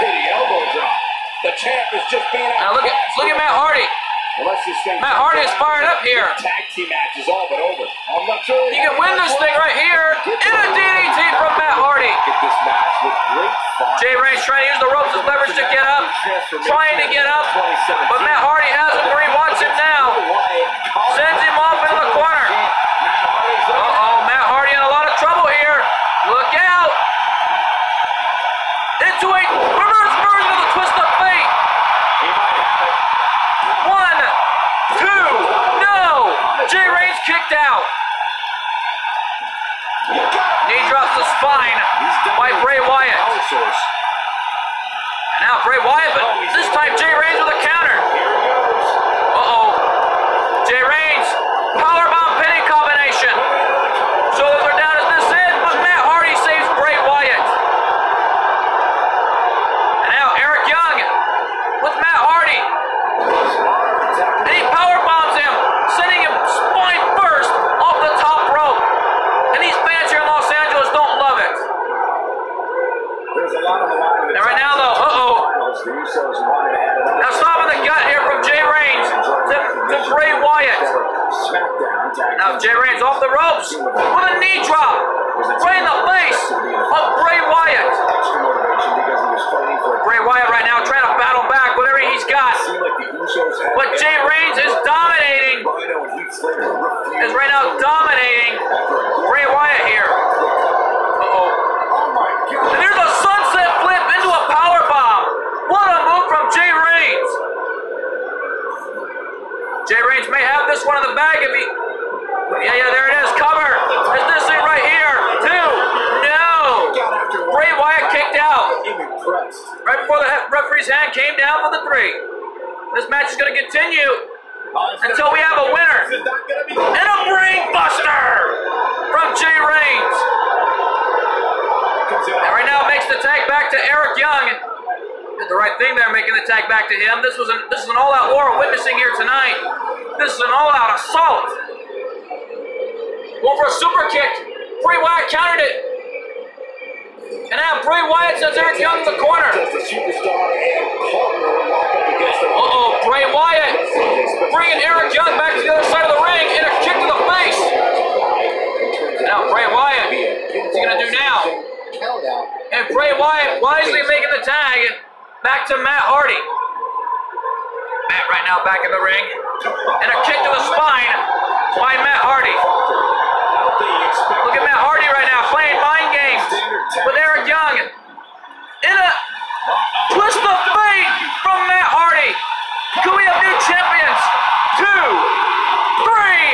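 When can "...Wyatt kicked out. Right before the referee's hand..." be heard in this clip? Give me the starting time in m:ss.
1:57.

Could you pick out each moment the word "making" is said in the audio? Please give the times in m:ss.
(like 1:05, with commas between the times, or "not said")
2:16, 2:44.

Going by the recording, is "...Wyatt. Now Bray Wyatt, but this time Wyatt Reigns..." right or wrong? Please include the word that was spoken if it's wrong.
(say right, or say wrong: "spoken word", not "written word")
wrong: "Jay", not "Wyatt".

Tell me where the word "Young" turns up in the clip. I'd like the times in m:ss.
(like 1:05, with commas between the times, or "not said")
2:14, 2:28, 2:35, 2:57.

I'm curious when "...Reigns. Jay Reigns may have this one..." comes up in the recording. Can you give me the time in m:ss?
1:46.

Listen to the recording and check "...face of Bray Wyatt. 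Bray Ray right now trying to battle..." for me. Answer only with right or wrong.
wrong.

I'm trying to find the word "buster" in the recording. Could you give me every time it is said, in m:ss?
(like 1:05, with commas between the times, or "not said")
2:07.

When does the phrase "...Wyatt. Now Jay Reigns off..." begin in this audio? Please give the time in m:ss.
1:20.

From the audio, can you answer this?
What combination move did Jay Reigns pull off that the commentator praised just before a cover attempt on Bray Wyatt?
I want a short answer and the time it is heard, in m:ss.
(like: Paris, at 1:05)
sunset flip into a power bomb, at 1:43.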